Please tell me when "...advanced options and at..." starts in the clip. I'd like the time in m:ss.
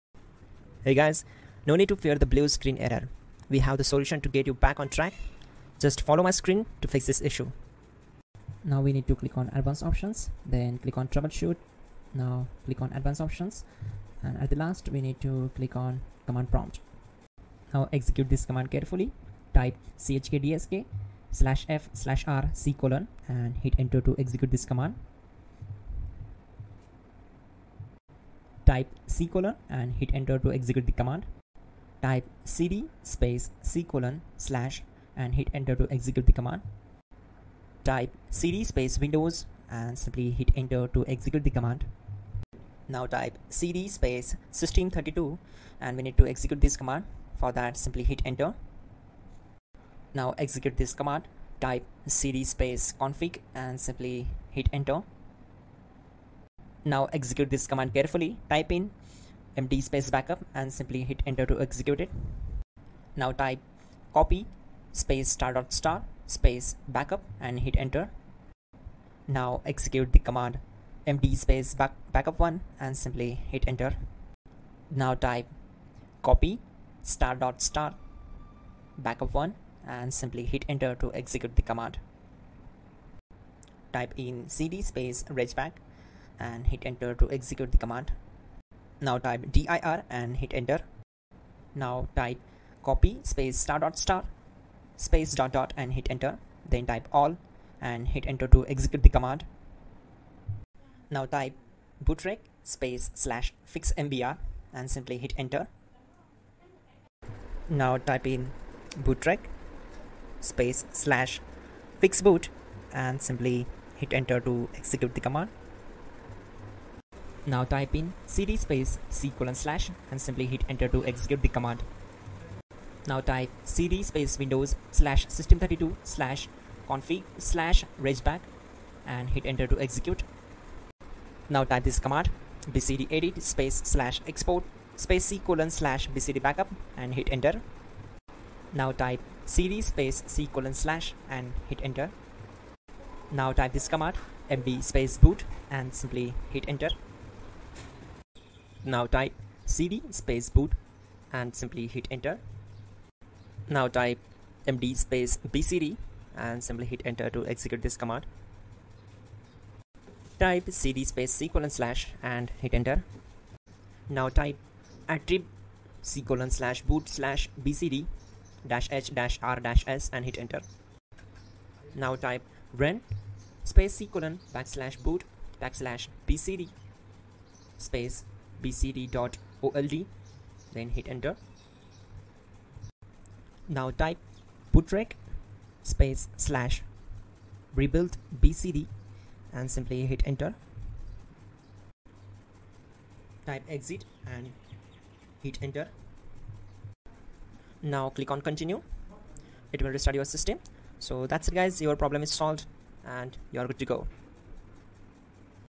0:12.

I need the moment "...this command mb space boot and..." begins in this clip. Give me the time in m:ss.
2:23.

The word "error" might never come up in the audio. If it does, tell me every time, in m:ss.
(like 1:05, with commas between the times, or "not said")
0:02.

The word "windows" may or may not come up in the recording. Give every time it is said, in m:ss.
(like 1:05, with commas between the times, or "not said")
0:38, 2:04.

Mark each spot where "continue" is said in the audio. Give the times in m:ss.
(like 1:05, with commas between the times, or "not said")
3:18.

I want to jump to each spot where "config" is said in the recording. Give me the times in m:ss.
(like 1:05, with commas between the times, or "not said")
0:52, 2:06.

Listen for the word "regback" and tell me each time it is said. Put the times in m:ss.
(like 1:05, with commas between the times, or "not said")
1:25, 2:07.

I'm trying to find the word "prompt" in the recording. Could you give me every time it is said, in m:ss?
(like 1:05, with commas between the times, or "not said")
0:16.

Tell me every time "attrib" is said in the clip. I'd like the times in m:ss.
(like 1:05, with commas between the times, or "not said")
2:45.